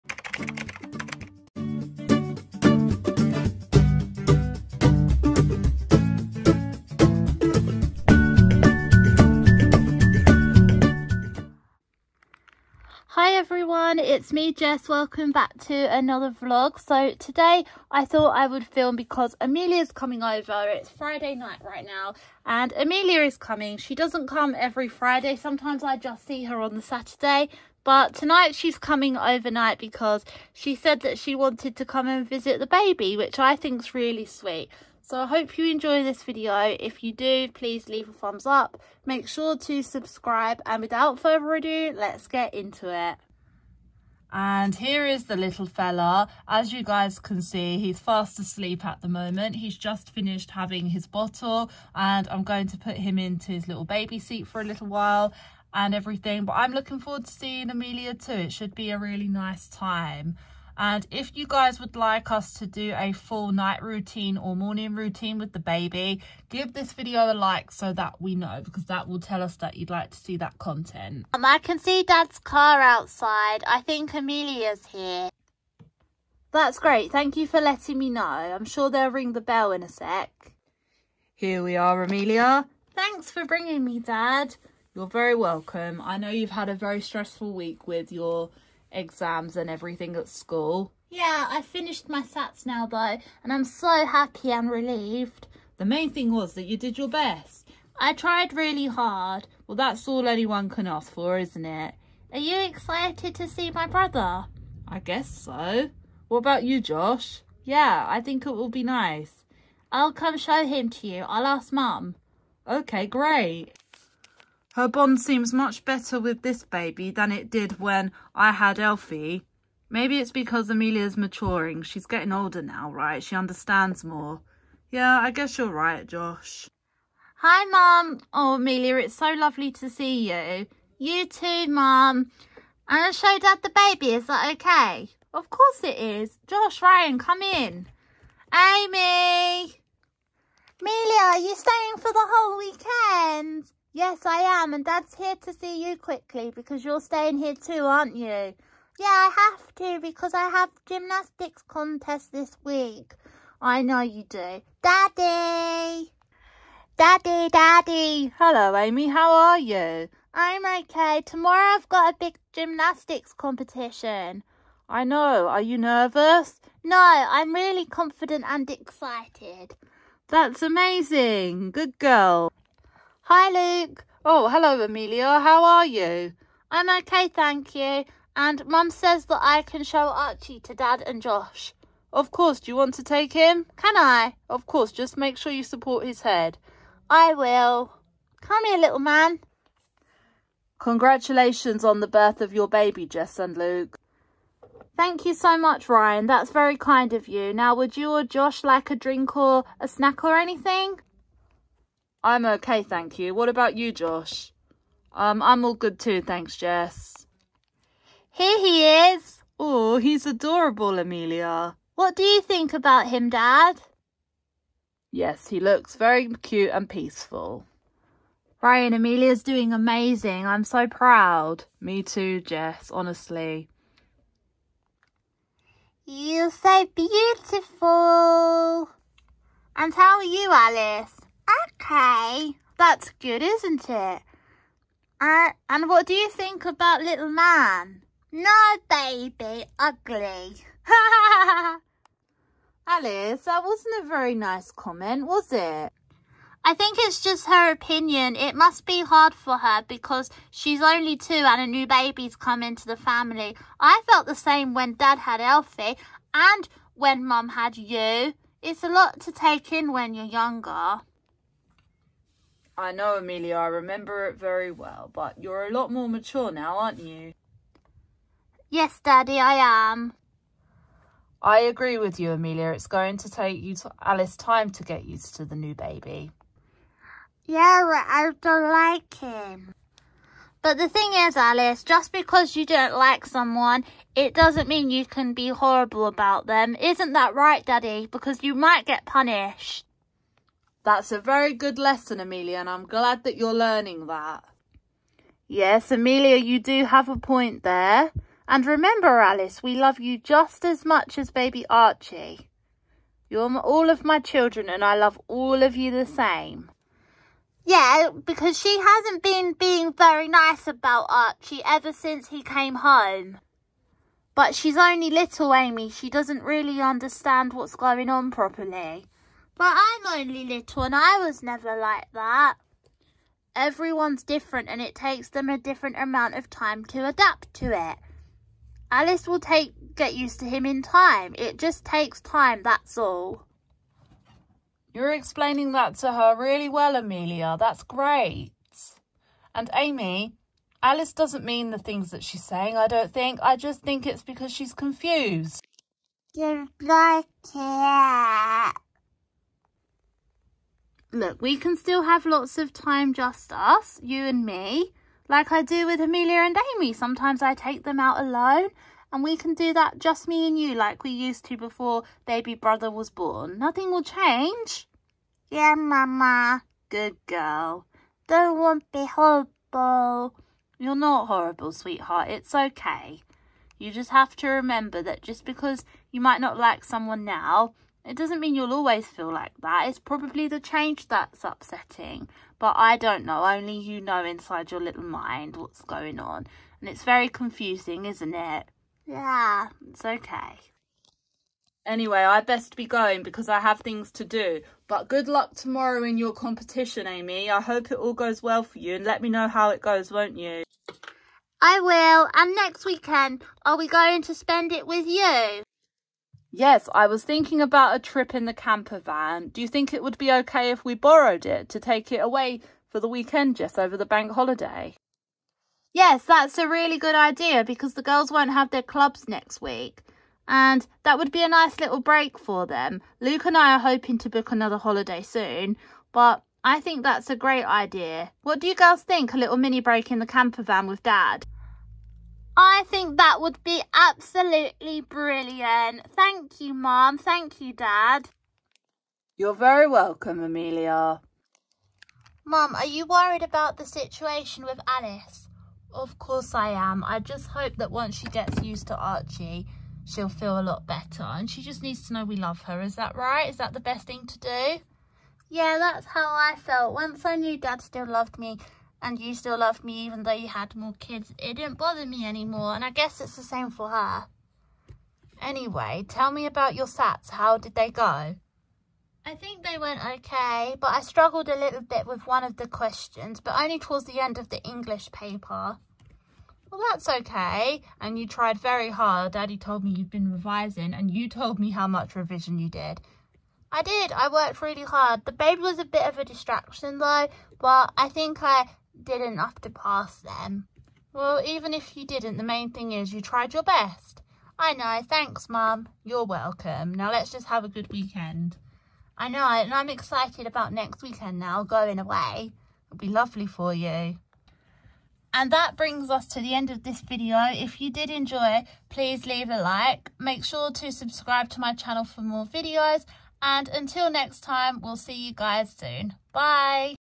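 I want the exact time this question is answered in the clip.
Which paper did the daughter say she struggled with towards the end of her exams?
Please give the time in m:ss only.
7:54.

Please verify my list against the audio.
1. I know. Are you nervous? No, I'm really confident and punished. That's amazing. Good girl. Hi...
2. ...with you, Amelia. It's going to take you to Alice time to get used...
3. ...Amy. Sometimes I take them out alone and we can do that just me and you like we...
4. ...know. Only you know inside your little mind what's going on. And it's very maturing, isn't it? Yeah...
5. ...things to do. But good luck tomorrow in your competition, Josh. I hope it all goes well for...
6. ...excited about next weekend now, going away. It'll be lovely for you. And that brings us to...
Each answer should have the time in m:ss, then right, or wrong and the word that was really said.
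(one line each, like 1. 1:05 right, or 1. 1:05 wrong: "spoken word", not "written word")
1. 2:44 wrong: "excited", not "punished"
2. 4:31 right
3. 5:56 right
4. 6:23 wrong: "confusing", not "maturing"
5. 6:33 wrong: "Amy", not "Josh"
6. 8:19 right.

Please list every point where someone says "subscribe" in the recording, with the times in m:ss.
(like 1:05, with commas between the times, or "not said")
0:39, 8:30.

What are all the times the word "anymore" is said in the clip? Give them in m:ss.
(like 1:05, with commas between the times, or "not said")
7:42.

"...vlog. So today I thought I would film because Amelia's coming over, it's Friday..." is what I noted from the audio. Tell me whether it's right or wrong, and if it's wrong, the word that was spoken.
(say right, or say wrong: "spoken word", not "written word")
right.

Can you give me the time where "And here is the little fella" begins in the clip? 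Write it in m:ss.
0:44.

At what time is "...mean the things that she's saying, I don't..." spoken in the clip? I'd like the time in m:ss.
5:41.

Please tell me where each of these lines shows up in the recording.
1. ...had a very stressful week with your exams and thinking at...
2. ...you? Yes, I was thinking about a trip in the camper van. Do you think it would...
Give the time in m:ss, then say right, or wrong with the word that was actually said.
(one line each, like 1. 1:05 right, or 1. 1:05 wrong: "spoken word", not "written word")
1. 1:26 wrong: "everything", not "thinking"
2. 6:45 right.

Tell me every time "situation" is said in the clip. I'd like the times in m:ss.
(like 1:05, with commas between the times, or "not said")
7:23.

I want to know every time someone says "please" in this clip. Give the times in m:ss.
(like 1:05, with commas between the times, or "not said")
0:37, 8:28.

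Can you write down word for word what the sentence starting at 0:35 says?
So I hope you enjoy this video.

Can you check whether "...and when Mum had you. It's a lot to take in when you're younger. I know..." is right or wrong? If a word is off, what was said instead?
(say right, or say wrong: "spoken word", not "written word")
right.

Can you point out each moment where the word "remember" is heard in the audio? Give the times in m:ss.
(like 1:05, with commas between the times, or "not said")
4:23, 4:58, 6:14.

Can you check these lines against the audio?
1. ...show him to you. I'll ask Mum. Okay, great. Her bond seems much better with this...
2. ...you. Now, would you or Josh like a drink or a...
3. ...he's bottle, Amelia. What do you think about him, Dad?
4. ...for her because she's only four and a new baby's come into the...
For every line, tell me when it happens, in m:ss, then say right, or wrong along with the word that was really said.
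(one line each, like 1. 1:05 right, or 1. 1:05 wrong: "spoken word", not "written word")
1. 1:50 right
2. 3:17 right
3. 3:29 wrong: "adorable", not "bottle"
4. 4:09 wrong: "two", not "four".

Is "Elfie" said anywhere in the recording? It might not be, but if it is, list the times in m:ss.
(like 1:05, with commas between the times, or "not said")
1:58, 4:15.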